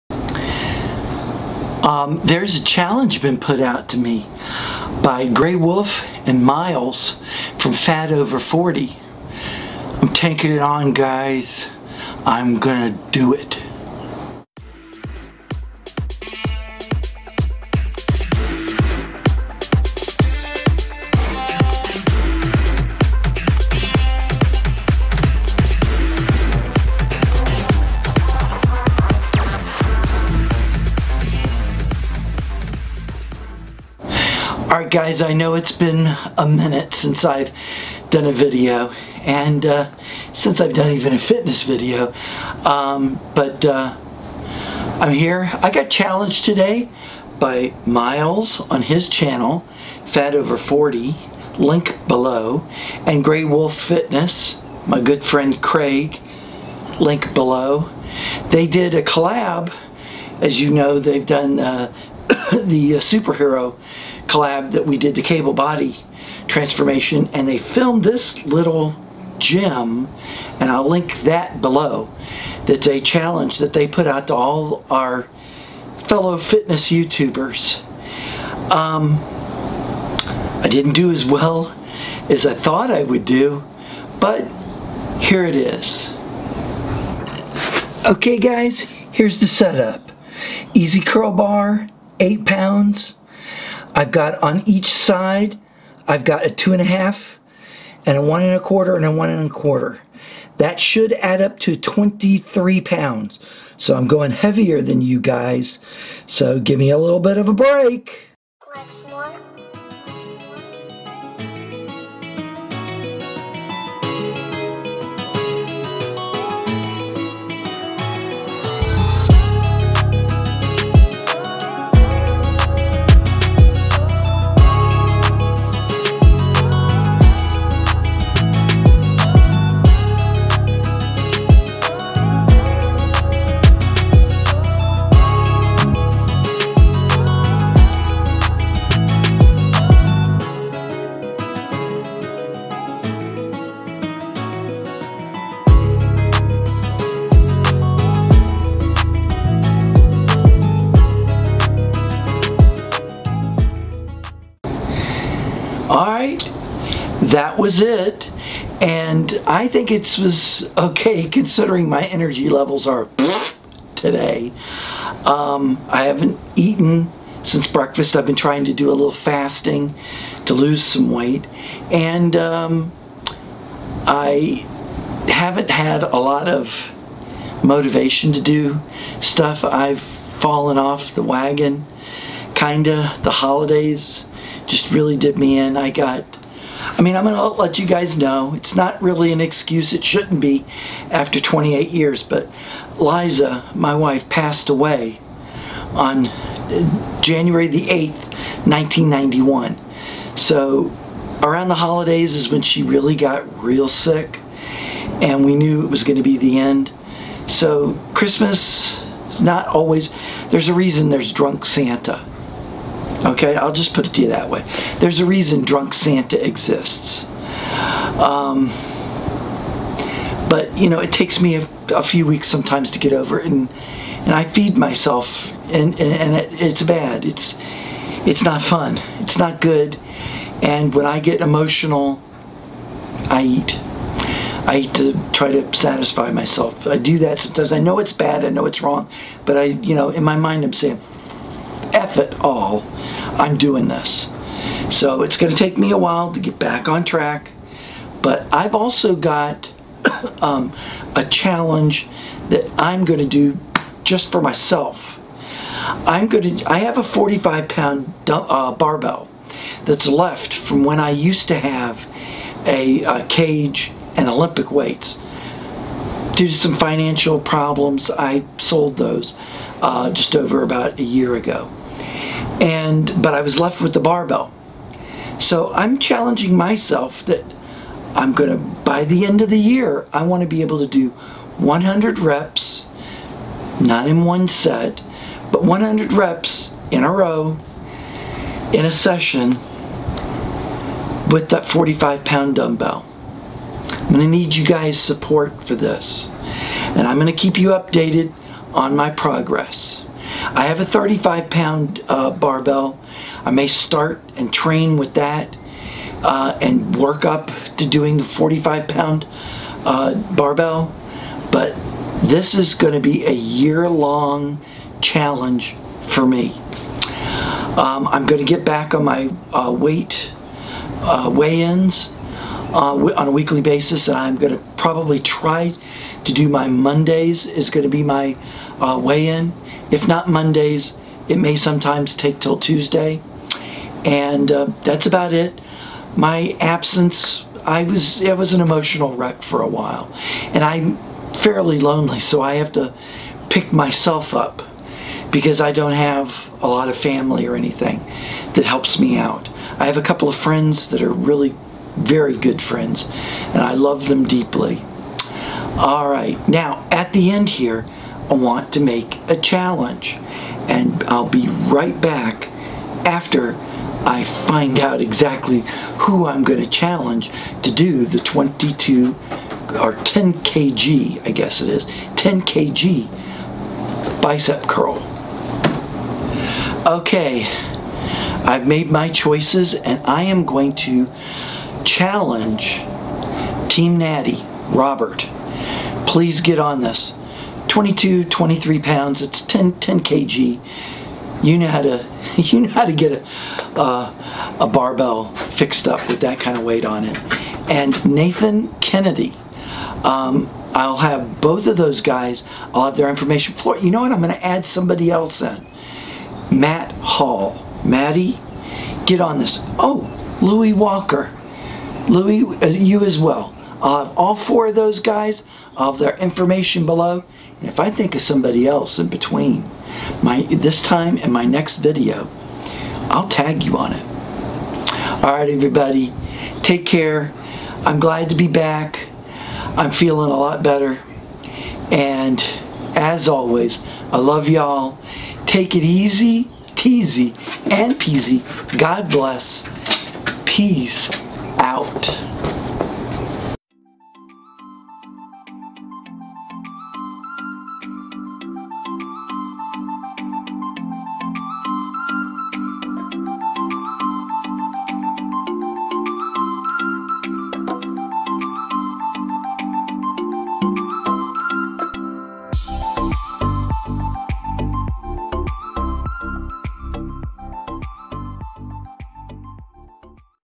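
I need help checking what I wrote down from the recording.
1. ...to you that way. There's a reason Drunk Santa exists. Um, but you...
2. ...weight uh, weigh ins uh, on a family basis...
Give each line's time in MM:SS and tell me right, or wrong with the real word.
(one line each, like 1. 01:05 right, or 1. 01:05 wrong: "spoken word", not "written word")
1. 03:34 right
2. 05:19 wrong: "weekly", not "family".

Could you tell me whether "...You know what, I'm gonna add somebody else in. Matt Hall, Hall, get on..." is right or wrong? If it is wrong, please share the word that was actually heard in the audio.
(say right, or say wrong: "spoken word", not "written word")
wrong: "Maddie", not "Hall".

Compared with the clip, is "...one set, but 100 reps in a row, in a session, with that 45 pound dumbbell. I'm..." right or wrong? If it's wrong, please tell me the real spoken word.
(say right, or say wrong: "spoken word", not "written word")
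right.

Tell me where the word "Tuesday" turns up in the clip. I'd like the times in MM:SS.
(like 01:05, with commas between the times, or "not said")
05:32.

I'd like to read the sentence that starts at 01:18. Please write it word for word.
Um, I didn't do as well as I thought I would do but here it is.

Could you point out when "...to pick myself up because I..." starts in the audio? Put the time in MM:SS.
05:42.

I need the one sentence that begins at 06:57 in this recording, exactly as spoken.
And if I think of somebody else in between, my this time and my next video, I'll tag you on it.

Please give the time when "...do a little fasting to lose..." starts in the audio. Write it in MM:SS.
02:48.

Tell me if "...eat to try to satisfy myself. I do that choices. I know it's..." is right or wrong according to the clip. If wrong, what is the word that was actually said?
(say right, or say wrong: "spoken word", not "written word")
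wrong: "sometimes", not "choices".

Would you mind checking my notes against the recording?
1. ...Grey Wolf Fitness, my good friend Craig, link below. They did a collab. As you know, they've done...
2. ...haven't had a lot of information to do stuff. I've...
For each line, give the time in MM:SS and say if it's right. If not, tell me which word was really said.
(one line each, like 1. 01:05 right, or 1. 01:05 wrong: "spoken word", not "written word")
1. 00:53 right
2. 02:55 wrong: "motivation", not "information".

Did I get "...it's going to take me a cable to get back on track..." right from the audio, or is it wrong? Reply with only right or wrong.
wrong.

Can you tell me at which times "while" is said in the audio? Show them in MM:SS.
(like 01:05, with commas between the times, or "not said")
04:05, 05:39.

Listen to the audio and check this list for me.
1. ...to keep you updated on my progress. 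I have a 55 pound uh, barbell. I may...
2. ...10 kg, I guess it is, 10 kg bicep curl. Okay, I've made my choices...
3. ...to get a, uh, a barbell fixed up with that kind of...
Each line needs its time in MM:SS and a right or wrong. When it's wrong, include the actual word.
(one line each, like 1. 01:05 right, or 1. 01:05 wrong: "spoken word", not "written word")
1. 04:57 wrong: "35", not "55"
2. 06:09 right
3. 06:32 right.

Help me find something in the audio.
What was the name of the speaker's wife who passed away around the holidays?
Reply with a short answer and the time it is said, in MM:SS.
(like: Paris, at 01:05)
Liza, at 03:12.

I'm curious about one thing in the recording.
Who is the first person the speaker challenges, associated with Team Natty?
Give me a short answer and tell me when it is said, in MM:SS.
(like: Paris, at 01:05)
Robert, at 06:24.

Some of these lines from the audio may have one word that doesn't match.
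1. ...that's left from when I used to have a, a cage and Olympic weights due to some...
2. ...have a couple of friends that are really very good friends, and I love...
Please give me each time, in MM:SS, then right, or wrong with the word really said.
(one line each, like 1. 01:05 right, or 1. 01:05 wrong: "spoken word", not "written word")
1. 04:19 right
2. 05:49 right.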